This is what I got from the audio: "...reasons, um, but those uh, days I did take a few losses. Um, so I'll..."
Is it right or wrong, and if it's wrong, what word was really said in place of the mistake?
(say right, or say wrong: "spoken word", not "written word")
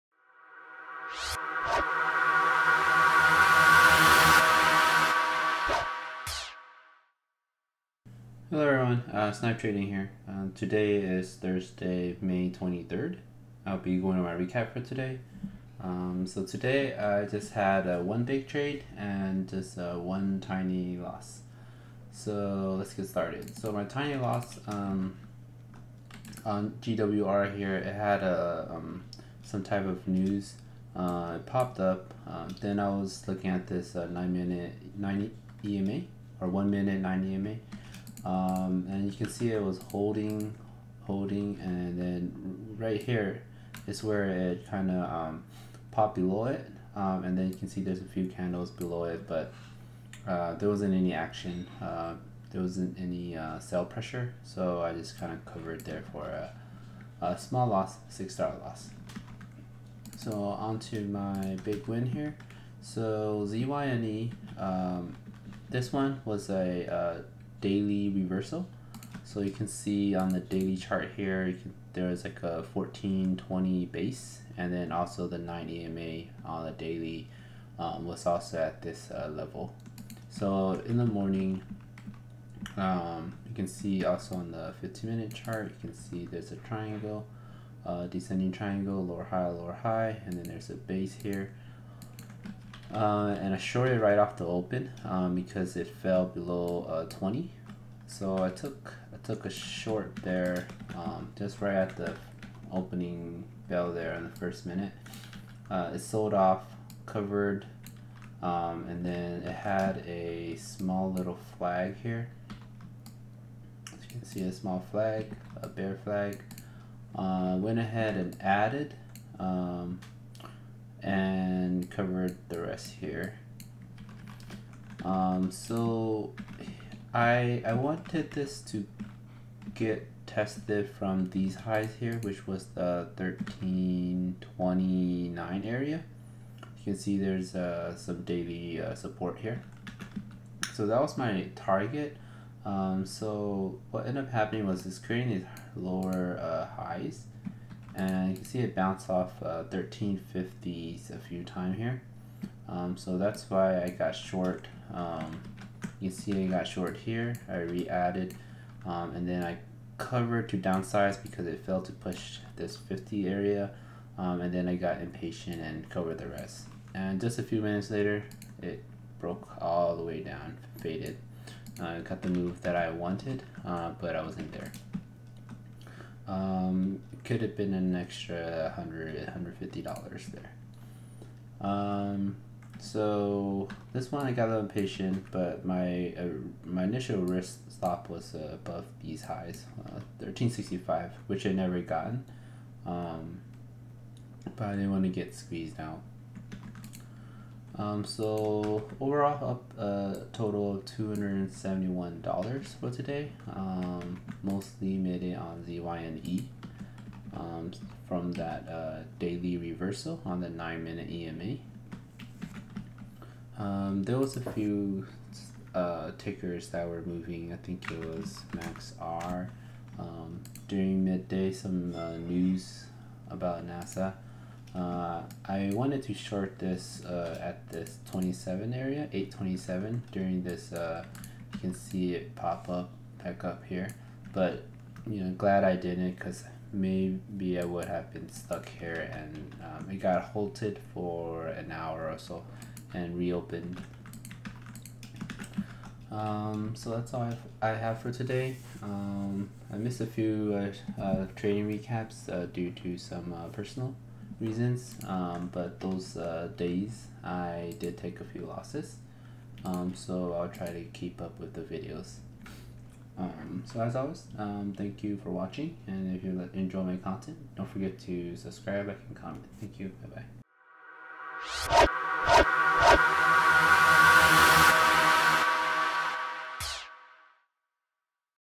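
right.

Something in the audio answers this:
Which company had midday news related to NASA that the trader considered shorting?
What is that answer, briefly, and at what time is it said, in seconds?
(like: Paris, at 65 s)
Maxar, at 218 s.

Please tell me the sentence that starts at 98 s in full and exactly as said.
So I took I took a short there, um, just right at the opening bell there in the first minute.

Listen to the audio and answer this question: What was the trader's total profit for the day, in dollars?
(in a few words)
$271.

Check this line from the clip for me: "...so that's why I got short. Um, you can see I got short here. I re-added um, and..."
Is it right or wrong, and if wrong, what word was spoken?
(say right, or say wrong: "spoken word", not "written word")
right.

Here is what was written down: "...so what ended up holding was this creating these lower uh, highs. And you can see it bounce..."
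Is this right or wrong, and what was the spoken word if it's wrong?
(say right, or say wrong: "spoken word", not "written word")
wrong: "happening", not "holding".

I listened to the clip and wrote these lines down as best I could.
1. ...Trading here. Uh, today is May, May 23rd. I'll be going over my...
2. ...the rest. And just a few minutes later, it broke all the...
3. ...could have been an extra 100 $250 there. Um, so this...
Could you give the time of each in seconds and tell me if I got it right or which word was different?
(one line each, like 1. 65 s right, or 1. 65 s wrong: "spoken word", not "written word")
1. 9 s wrong: "Thursday", not "May"
2. 166 s right
3. 177 s wrong: "150", not "250".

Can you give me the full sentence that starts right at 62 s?
So ZYNE, um, this one was a uh, daily reversal.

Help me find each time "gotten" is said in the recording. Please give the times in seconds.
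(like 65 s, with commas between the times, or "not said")
191 s.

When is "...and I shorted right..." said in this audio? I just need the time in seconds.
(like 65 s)
93 s.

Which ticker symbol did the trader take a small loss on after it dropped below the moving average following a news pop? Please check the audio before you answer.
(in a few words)
GWR.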